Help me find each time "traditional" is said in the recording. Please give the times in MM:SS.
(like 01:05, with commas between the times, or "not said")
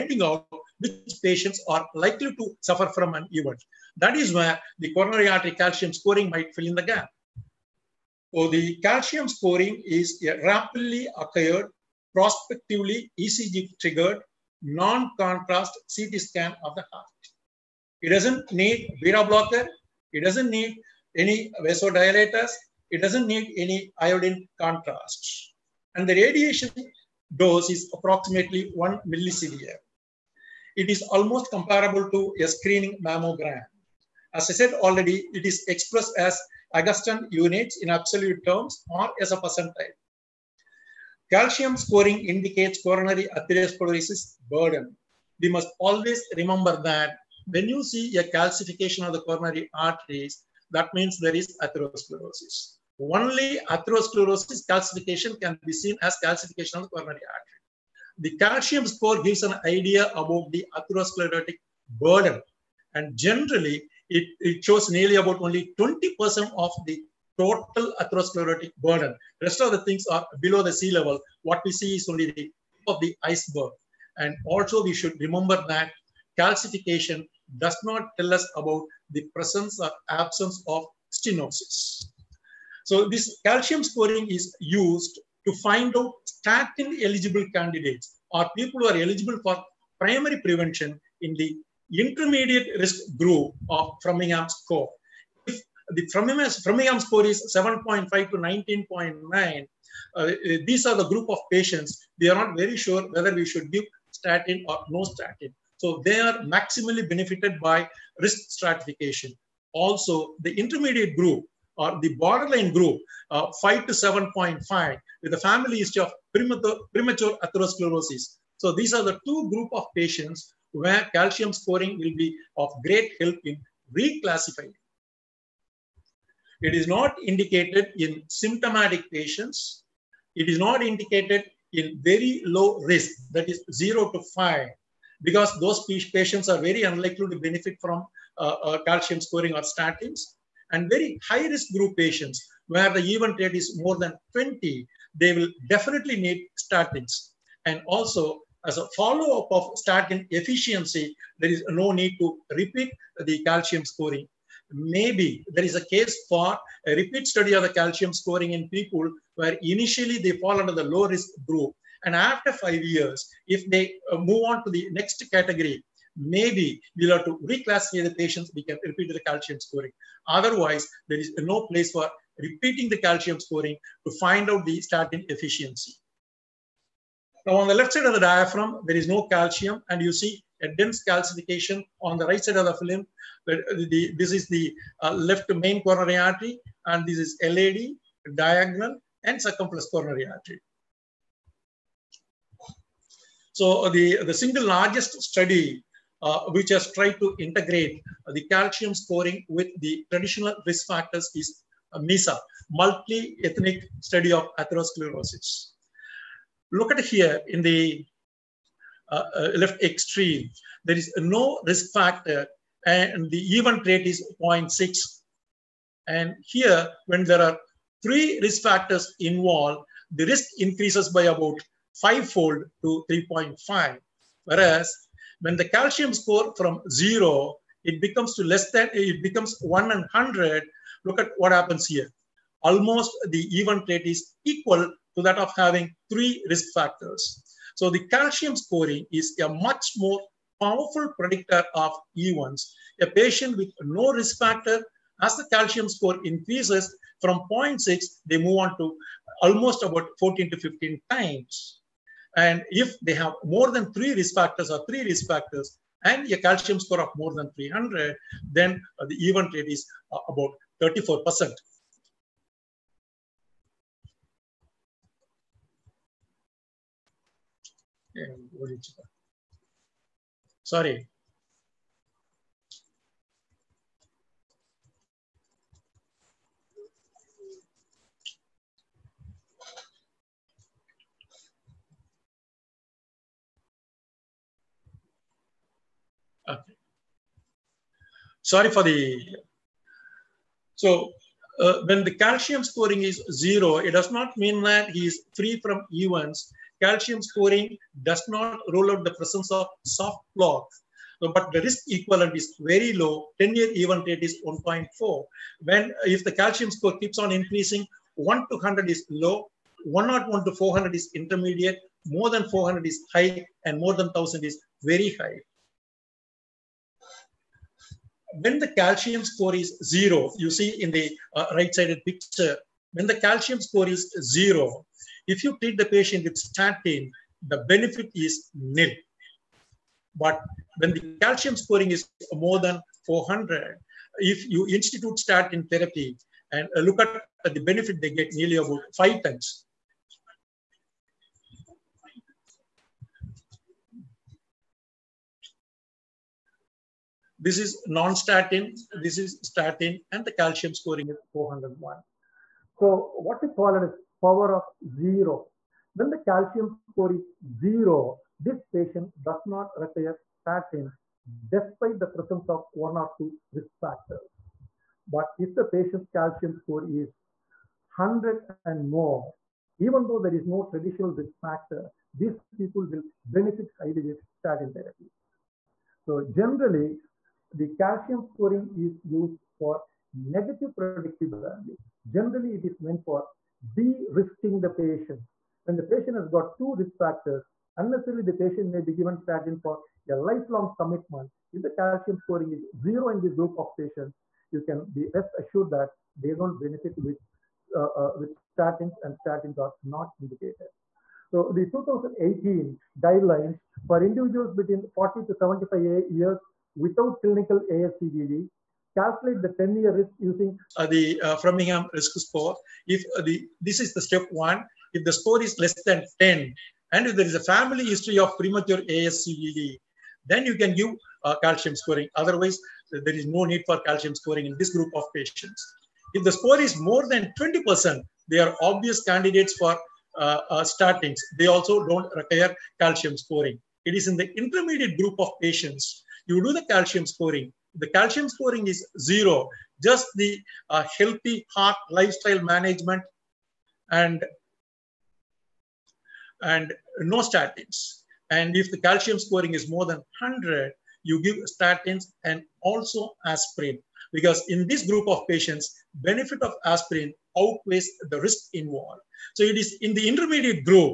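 03:20, 06:10.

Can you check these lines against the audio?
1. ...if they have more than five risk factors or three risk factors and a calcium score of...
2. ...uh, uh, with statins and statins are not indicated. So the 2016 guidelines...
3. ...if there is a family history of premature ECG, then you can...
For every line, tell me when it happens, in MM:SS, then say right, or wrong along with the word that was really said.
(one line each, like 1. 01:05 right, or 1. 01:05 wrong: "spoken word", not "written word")
1. 04:12 wrong: "three", not "five"
2. 06:37 wrong: "2018", not "2016"
3. 06:57 wrong: "ASCVD", not "ECG".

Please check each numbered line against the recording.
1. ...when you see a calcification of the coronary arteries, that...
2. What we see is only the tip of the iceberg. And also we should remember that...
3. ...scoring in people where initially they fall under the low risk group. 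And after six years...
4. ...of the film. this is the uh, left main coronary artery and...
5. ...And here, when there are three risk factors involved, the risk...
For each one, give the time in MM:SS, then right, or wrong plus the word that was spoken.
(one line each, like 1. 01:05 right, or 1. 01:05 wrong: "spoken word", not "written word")
1. 00:47 right
2. 01:11 right
3. 02:38 wrong: "five", not "six"
4. 03:02 right
5. 03:36 right.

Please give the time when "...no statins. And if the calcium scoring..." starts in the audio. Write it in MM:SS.
07:26.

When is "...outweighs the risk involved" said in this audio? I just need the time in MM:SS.
07:37.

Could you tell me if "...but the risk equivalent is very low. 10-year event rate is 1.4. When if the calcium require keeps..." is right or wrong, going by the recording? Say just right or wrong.
wrong.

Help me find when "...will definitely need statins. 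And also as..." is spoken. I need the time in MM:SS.
02:25.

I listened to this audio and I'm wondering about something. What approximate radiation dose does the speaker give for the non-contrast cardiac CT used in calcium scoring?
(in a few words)
1 millisievert.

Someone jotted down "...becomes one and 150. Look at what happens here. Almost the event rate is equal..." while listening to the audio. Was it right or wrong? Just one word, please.
wrong.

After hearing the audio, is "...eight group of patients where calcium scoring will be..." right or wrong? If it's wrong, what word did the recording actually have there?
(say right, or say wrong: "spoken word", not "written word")
wrong: "two", not "eight".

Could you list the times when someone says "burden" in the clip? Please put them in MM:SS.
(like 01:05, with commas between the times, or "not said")
00:44, 01:01, 01:08.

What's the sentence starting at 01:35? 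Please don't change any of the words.
If the Framingham, score is 7.5 to 19.9, uh, these are the group of patients.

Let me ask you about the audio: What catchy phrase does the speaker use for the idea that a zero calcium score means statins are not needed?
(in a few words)
power of zero.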